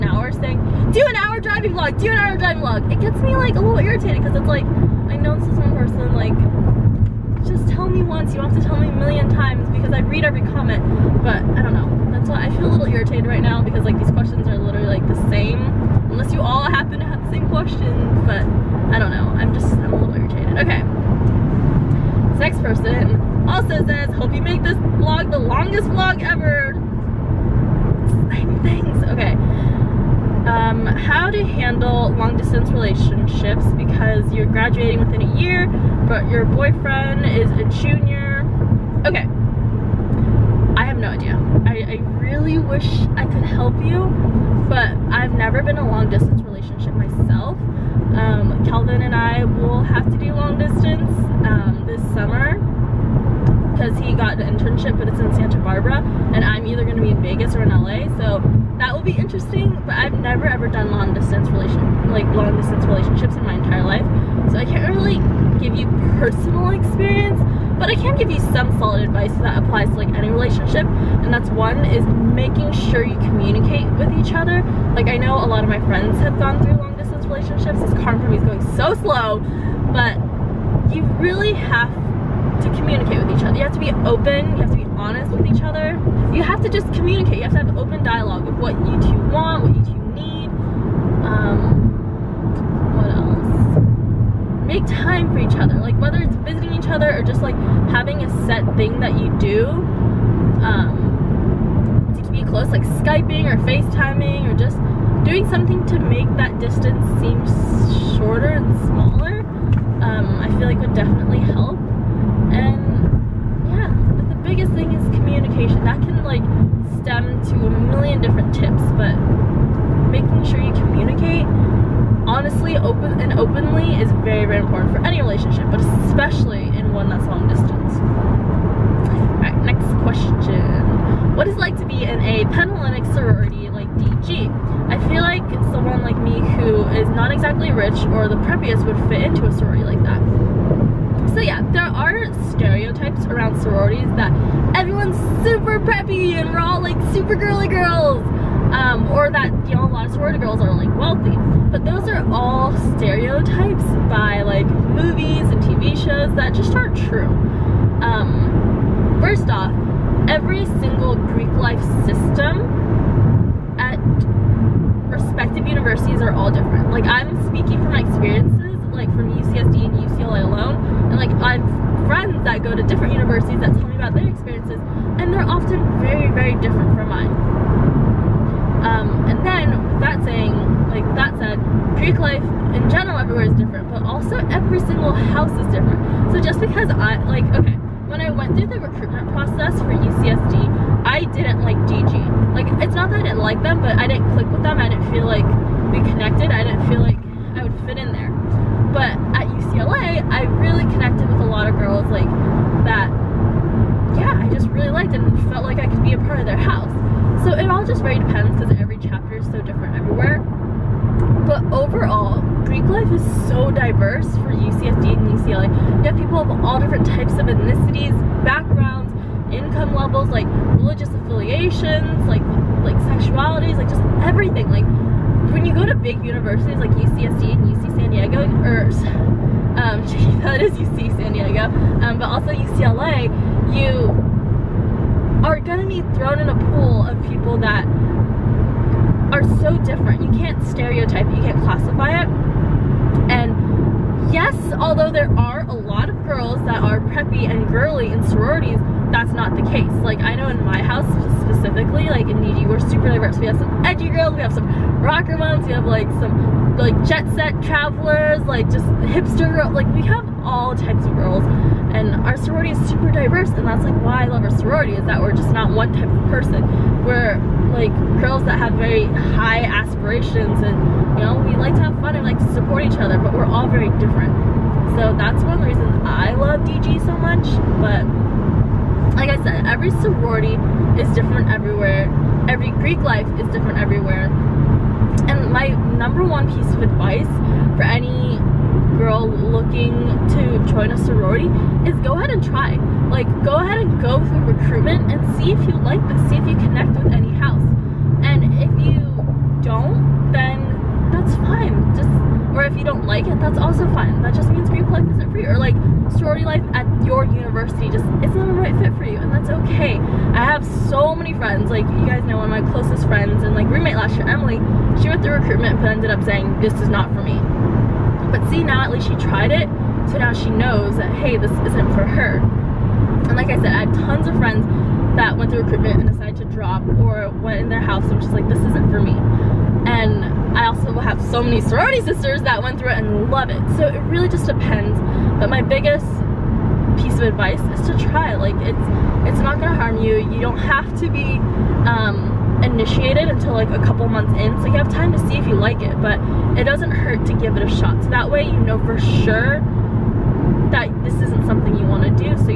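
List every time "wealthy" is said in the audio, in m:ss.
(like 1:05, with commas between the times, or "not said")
2:30.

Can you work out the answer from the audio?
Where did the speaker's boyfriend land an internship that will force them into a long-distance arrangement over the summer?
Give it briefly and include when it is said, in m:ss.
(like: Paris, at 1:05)
Santa Barbara, at 0:55.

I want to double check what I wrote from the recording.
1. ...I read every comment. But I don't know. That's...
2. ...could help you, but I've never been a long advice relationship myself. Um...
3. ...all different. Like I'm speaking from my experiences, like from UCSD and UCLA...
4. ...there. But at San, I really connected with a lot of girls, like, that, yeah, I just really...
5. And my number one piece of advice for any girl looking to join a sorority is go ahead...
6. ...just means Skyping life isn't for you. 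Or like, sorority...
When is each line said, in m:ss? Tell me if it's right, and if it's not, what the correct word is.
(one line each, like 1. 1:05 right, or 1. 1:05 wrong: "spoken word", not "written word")
1. 0:09 right
2. 0:43 wrong: "distance", not "advice"
3. 2:46 right
4. 3:18 wrong: "UCLA", not "San"
5. 4:45 right
6. 5:04 wrong: "Greek", not "Skyping".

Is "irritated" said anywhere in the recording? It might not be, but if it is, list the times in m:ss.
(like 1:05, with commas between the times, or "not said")
0:03, 0:12, 0:20.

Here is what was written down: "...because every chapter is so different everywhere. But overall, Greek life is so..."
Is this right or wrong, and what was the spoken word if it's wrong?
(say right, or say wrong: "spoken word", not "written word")
right.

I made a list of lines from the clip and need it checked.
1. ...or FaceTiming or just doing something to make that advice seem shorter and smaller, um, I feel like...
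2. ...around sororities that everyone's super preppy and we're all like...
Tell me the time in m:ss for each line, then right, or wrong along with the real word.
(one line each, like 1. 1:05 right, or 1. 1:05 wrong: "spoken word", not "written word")
1. 1:43 wrong: "distance", not "advice"
2. 2:23 right.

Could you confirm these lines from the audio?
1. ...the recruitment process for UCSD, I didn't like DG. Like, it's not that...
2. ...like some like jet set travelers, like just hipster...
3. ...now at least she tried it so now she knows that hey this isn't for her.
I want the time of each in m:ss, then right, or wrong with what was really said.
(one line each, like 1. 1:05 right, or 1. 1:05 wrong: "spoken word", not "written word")
1. 3:08 right
2. 4:15 right
3. 5:18 right.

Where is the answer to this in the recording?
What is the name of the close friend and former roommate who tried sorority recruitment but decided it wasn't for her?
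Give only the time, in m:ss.
5:14.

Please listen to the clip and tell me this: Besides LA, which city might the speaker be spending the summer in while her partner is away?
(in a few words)
Vegas.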